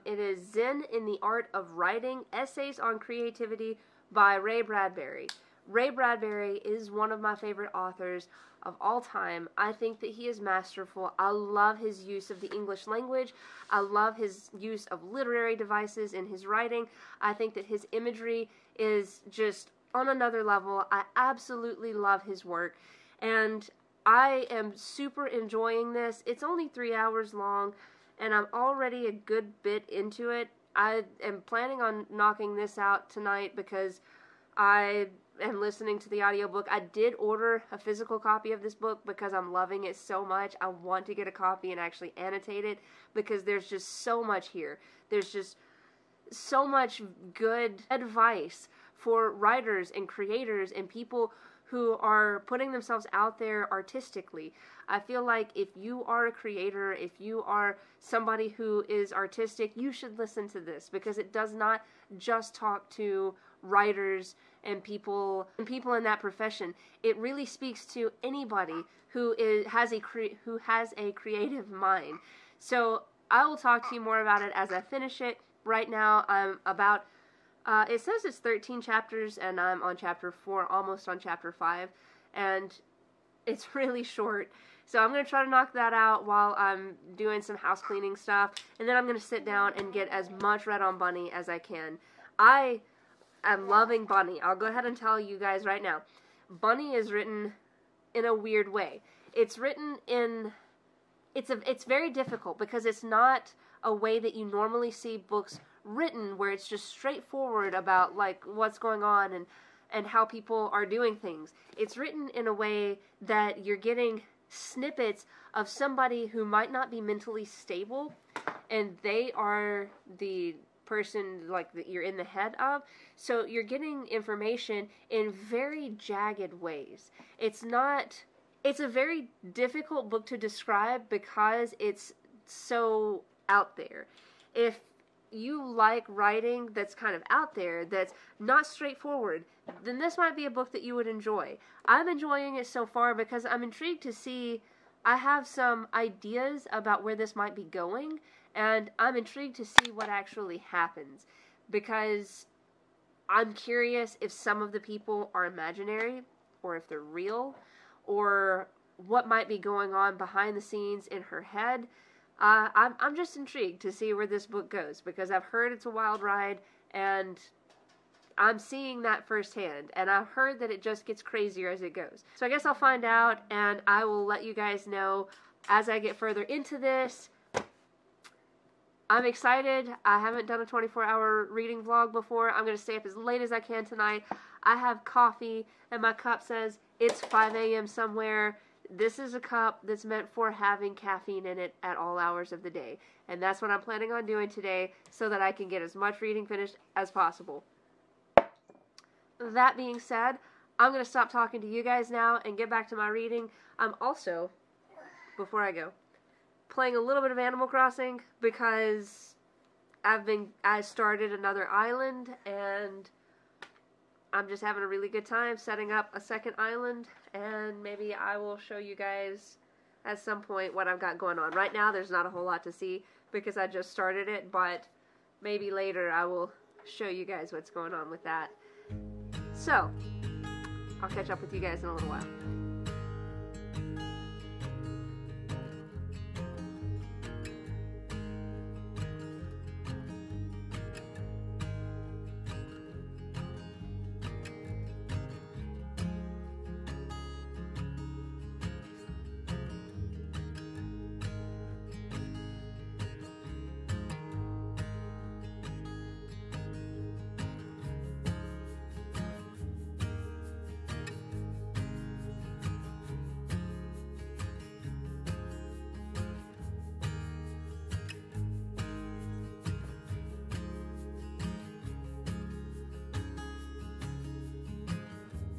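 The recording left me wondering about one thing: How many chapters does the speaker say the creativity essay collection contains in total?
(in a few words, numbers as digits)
13.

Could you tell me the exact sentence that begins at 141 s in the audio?
I'm enjoying it so far because I'm intrigued to see.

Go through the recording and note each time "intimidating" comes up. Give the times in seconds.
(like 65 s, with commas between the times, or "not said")
not said.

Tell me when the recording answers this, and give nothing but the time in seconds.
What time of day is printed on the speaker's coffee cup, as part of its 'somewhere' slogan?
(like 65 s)
187 s.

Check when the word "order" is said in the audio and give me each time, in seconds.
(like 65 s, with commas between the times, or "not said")
37 s.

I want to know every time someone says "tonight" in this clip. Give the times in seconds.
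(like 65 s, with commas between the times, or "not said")
33 s, 183 s.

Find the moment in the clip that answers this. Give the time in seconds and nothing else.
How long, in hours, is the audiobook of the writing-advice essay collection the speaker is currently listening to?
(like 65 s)
26 s.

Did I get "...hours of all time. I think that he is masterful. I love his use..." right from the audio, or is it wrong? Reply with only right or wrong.
wrong.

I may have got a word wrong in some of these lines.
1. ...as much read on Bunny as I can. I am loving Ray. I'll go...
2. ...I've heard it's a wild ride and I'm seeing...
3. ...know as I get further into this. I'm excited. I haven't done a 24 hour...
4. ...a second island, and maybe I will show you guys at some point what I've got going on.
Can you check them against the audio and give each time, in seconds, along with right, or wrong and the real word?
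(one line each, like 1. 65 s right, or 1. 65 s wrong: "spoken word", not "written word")
1. 90 s wrong: "Bunny", not "Ray"
2. 165 s right
3. 174 s right
4. 216 s right.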